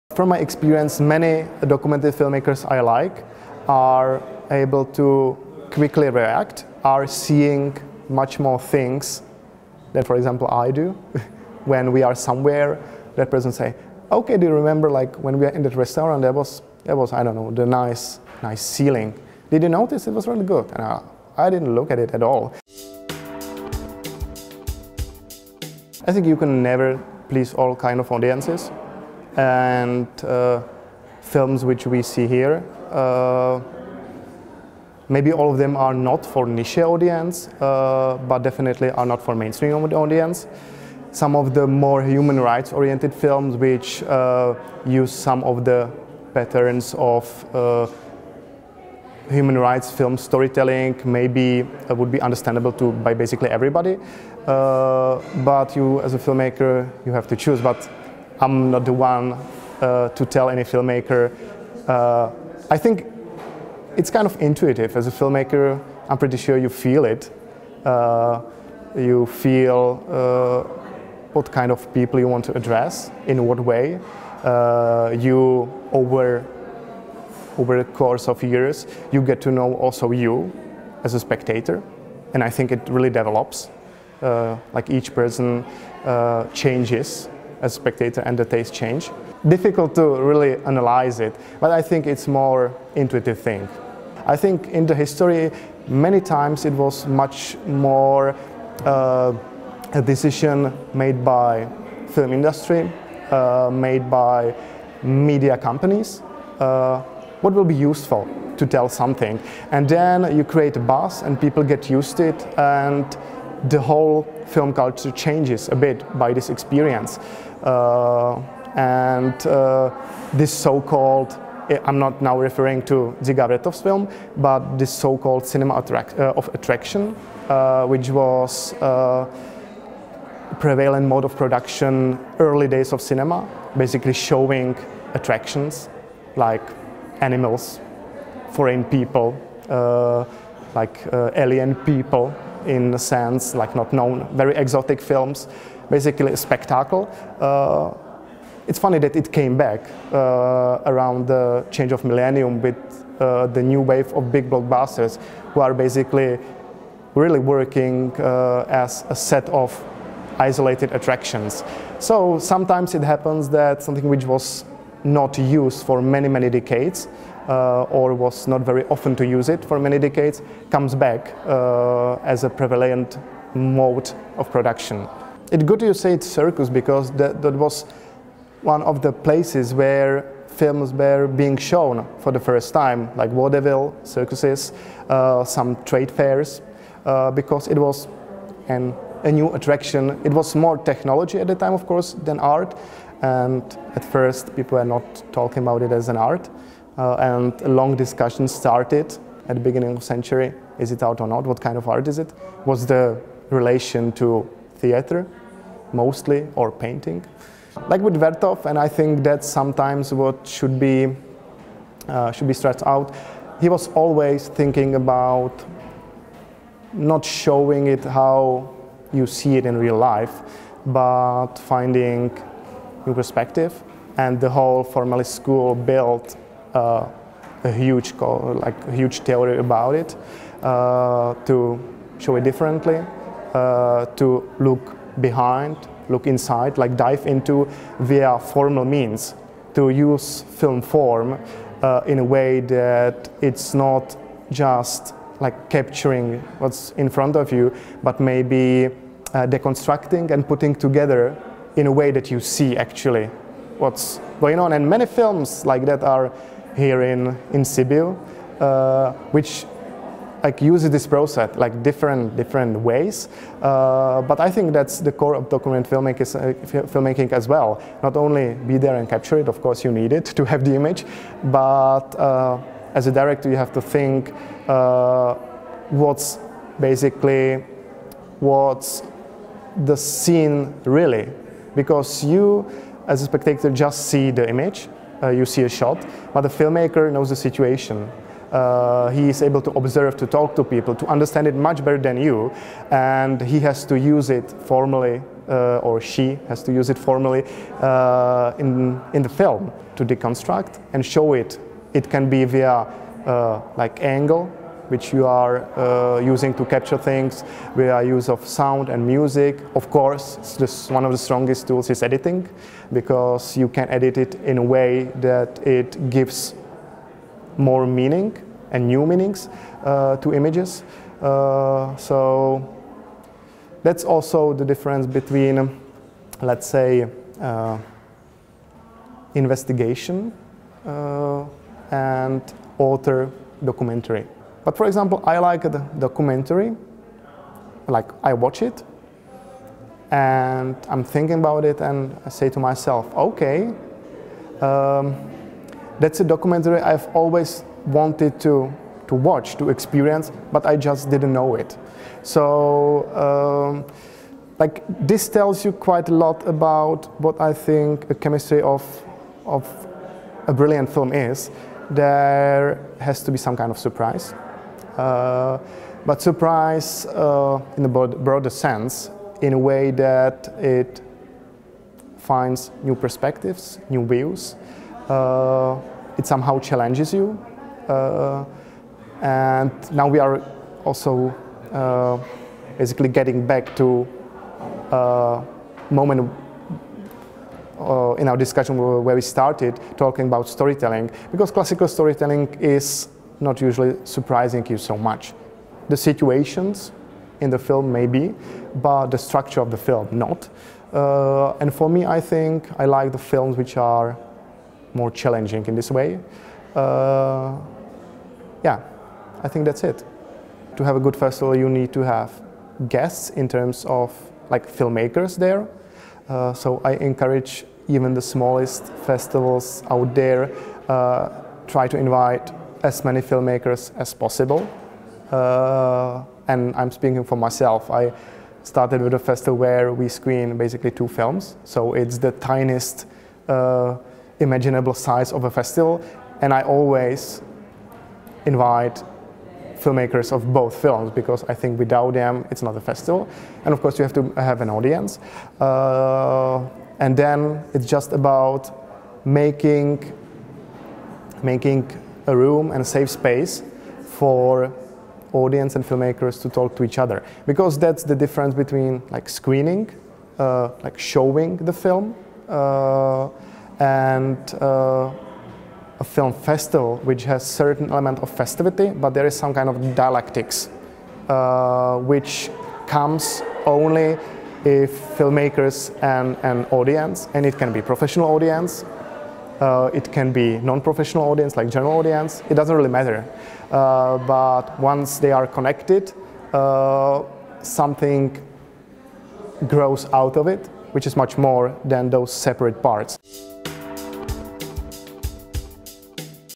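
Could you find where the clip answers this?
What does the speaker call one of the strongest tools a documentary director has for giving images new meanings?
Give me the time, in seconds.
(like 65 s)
312 s.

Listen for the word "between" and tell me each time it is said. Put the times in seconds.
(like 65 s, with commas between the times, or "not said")
325 s, 458 s.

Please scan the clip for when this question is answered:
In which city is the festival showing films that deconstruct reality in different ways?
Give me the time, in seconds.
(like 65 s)
257 s.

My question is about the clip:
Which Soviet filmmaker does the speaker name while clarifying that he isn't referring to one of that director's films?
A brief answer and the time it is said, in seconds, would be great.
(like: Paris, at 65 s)
Dziga Vertov, at 123 s.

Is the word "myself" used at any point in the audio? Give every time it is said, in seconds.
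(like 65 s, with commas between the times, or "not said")
342 s, 427 s.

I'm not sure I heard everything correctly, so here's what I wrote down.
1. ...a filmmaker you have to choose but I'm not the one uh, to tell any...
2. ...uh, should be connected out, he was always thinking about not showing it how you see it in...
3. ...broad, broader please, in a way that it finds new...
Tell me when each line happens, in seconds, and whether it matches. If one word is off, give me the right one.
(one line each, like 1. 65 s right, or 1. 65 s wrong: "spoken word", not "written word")
1. 56 s right
2. 212 s wrong: "stressed", not "connected"
3. 367 s wrong: "sense", not "please".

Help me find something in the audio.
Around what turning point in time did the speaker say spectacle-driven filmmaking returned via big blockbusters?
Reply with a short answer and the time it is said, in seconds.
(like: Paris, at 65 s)
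change of millennium, at 151 s.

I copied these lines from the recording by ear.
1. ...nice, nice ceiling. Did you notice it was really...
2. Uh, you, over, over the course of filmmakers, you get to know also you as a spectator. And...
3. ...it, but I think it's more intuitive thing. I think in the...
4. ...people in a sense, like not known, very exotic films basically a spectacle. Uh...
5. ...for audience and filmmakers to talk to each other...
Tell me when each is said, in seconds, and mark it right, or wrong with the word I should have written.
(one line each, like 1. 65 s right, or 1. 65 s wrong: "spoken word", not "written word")
1. 17 s right
2. 74 s wrong: "years", not "filmmakers"
3. 91 s right
4. 141 s right
5. 454 s right.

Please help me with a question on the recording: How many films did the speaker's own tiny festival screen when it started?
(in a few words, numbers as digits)
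2.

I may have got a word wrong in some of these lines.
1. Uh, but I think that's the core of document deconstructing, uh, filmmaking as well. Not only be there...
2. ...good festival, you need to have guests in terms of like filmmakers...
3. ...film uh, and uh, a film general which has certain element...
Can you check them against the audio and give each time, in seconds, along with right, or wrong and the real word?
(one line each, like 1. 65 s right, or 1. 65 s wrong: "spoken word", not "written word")
1. 263 s wrong: "filmmaking", not "deconstructing"
2. 410 s right
3. 461 s wrong: "festival", not "general".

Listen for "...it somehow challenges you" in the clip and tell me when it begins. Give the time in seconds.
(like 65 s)
376 s.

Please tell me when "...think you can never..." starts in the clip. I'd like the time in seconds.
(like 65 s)
26 s.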